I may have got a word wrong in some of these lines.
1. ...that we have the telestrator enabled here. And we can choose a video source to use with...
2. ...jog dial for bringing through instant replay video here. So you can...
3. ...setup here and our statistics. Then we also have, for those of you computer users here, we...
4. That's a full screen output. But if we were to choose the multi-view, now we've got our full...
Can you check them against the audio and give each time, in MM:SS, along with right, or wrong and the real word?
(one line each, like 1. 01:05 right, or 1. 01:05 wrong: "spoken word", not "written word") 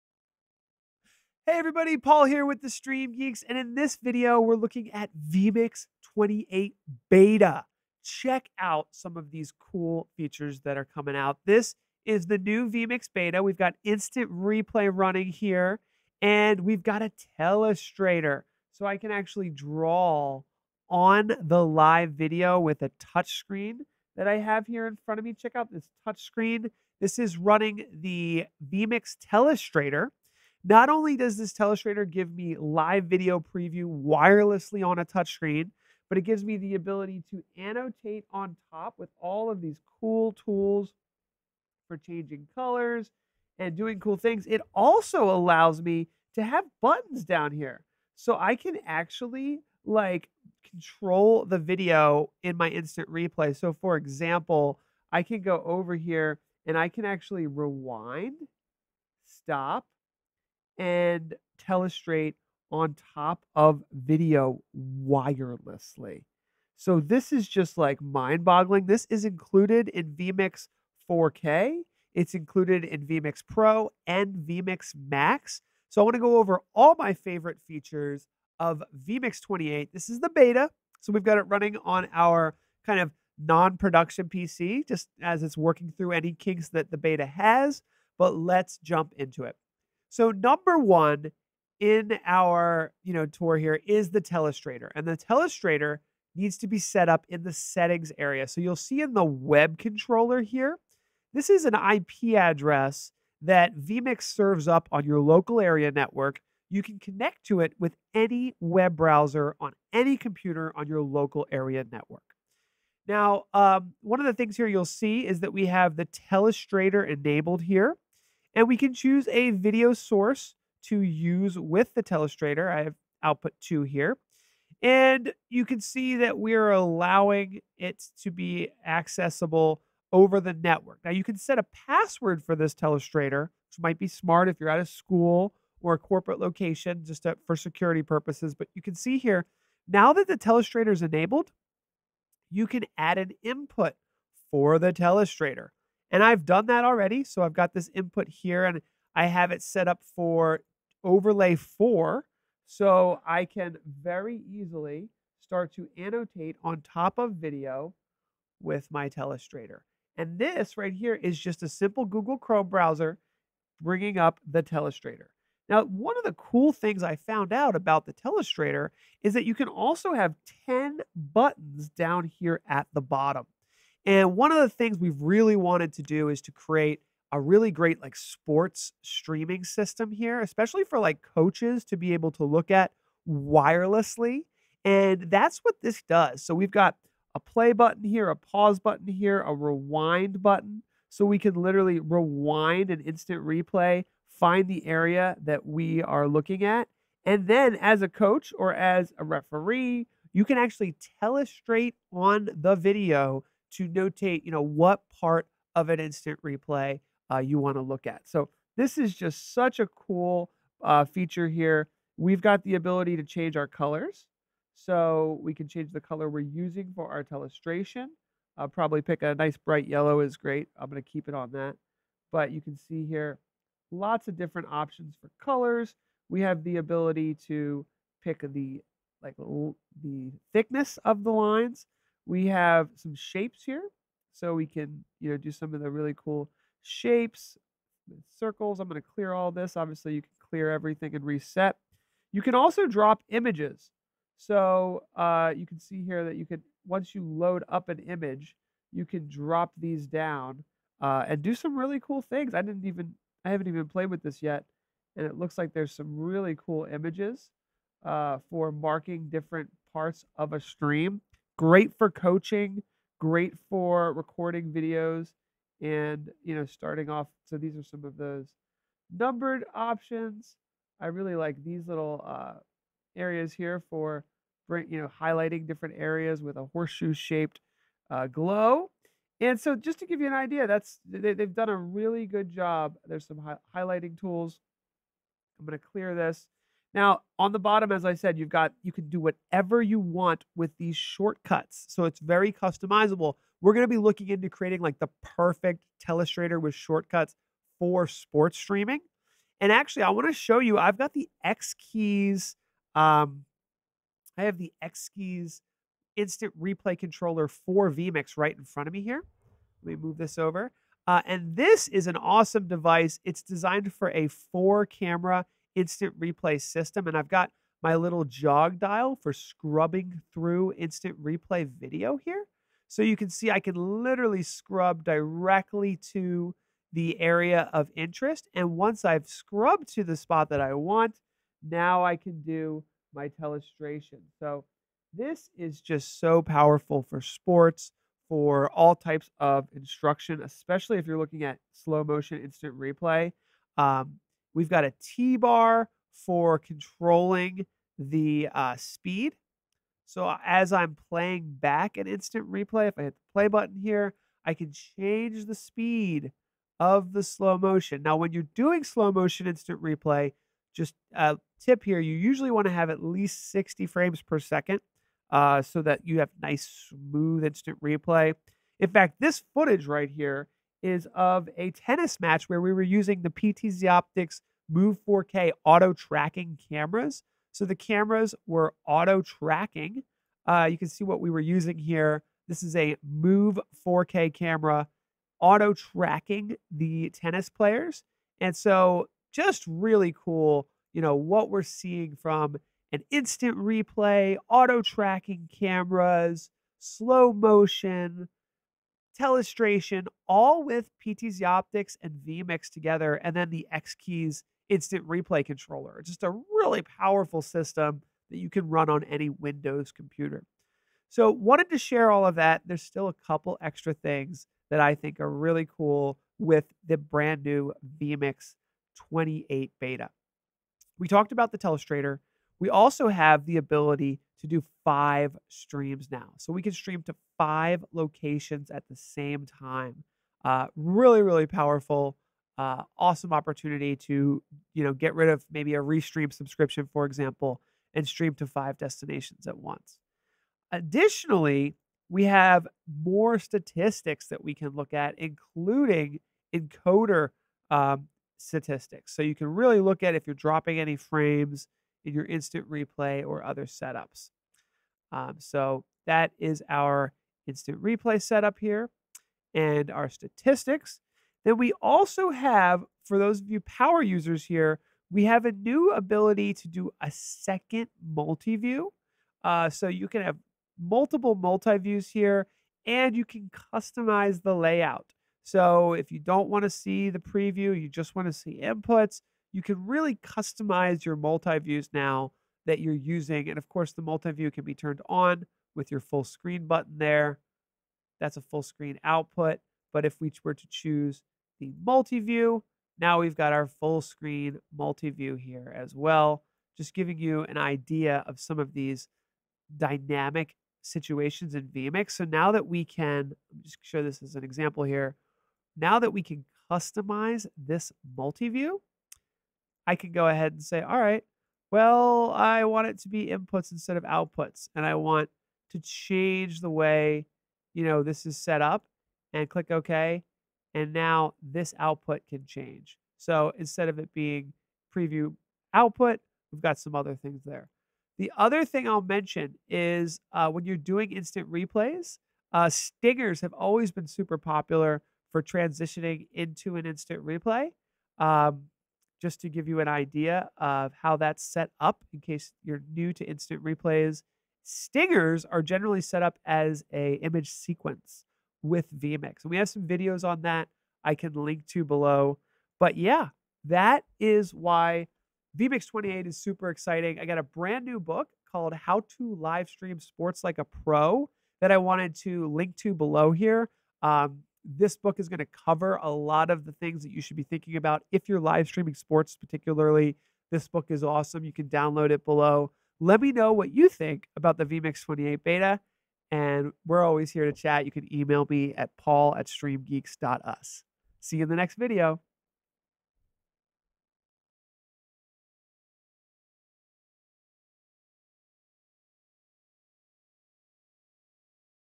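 1. 01:55 right
2. 05:18 wrong: "scrubbing", not "bringing"
3. 07:38 wrong: "power", not "computer"
4. 08:08 right.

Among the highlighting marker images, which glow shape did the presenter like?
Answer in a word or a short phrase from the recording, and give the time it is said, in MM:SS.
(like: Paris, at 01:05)
Horseshoe, at 04:36.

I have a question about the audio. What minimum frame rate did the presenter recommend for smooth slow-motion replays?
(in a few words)
60 frames per second.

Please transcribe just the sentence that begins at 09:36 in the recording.
And we're always here to chat.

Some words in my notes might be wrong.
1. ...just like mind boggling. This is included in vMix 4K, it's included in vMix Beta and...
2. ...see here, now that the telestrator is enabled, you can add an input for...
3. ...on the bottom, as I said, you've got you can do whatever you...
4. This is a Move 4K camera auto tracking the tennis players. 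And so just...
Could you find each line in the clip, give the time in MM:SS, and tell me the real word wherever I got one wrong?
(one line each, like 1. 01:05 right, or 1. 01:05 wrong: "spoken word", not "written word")
1. 01:07 wrong: "Pro", not "Beta"
2. 02:18 right
3. 04:47 right
4. 06:22 right.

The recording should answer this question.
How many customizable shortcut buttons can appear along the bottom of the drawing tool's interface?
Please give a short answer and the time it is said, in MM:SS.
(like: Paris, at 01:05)
10, at 02:50.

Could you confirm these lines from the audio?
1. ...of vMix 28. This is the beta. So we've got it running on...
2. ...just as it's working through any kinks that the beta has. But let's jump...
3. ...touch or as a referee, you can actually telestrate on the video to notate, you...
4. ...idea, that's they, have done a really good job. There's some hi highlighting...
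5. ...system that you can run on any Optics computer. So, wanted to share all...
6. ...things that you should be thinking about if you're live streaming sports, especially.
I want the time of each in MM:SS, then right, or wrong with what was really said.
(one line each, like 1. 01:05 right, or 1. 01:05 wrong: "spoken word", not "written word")
1. 01:18 right
2. 01:24 right
3. 03:18 wrong: "coach", not "touch"
4. 04:40 right
5. 06:47 wrong: "Windows", not "Optics"
6. 09:26 wrong: "particularly", not "especially".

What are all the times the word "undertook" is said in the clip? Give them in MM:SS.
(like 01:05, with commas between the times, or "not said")
not said.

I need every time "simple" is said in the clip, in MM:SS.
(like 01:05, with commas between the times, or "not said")
02:41.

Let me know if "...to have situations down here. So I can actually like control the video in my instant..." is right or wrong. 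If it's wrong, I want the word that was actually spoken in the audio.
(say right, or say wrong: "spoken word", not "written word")
wrong: "buttons", not "situations".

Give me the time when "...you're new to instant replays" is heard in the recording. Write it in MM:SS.
09:02.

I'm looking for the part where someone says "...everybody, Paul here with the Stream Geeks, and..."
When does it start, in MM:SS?
00:01.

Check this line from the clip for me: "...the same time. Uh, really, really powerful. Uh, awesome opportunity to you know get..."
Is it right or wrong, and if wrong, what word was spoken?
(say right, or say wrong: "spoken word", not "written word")
right.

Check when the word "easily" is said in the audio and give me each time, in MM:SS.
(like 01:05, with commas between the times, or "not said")
02:34.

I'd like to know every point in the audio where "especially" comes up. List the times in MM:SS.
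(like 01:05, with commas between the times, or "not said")
03:00, 05:40.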